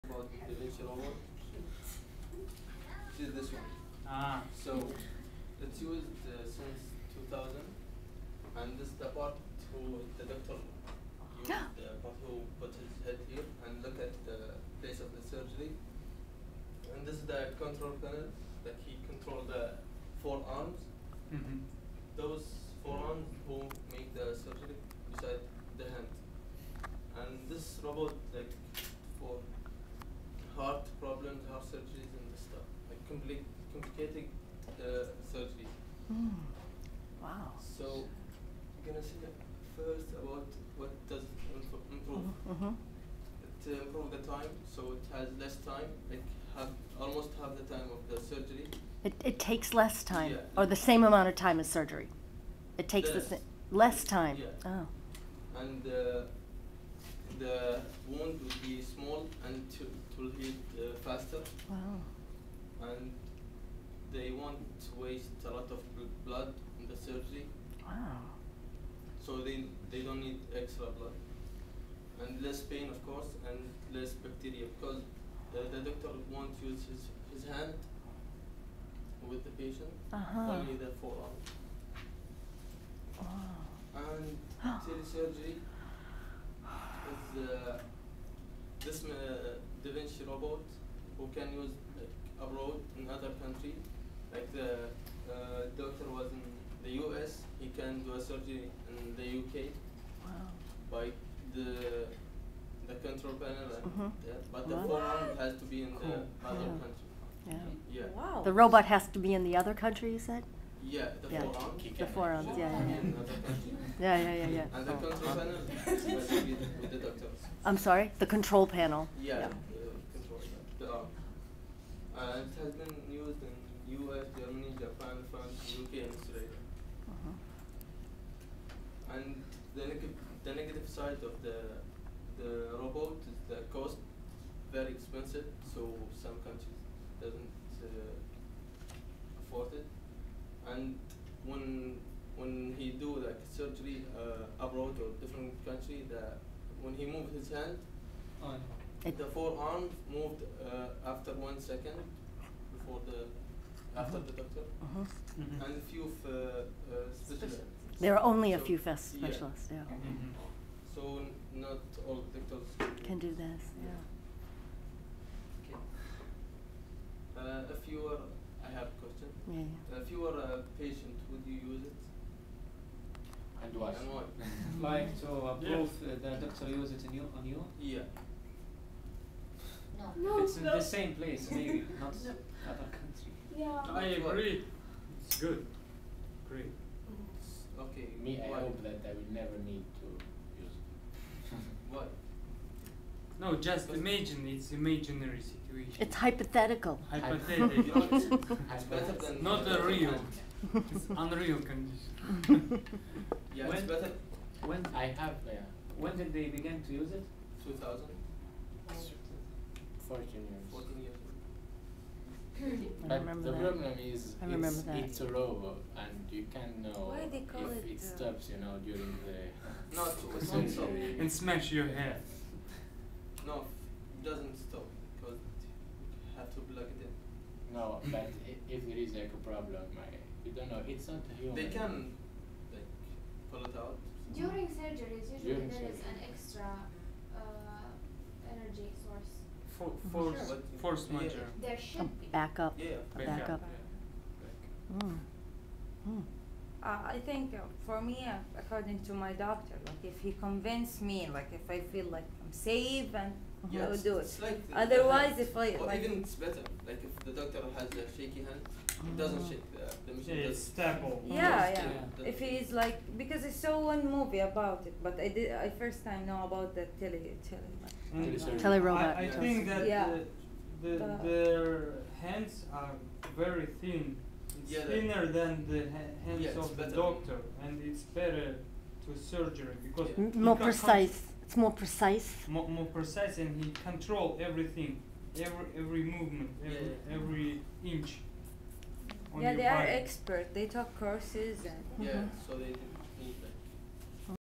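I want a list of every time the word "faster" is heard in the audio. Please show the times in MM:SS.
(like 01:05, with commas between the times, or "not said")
01:01.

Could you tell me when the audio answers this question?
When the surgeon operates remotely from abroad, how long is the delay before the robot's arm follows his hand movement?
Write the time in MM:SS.
02:31.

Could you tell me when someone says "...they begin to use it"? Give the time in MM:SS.
03:26.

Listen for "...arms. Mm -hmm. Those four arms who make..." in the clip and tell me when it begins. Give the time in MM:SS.
00:20.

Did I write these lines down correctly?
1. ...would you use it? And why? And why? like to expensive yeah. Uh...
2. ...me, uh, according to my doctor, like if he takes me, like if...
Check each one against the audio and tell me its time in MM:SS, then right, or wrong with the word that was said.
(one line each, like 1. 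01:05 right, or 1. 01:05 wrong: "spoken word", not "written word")
1. 02:51 wrong: "approve", not "expensive"
2. 04:08 wrong: "convinces", not "takes".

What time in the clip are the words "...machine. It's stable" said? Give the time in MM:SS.
04:20.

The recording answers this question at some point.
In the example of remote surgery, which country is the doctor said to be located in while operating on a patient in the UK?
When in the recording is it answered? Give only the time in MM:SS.
01:36.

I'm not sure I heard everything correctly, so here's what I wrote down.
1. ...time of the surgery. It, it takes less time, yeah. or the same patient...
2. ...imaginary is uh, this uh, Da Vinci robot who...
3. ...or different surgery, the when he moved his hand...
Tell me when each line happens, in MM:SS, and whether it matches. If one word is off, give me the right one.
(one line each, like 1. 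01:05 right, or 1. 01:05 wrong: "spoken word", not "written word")
1. 00:47 wrong: "amount", not "patient"
2. 01:25 wrong: "surgery", not "imaginary"
3. 02:24 wrong: "country", not "surgery".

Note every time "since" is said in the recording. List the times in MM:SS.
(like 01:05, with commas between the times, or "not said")
00:06.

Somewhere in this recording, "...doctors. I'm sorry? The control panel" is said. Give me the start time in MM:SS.
01:56.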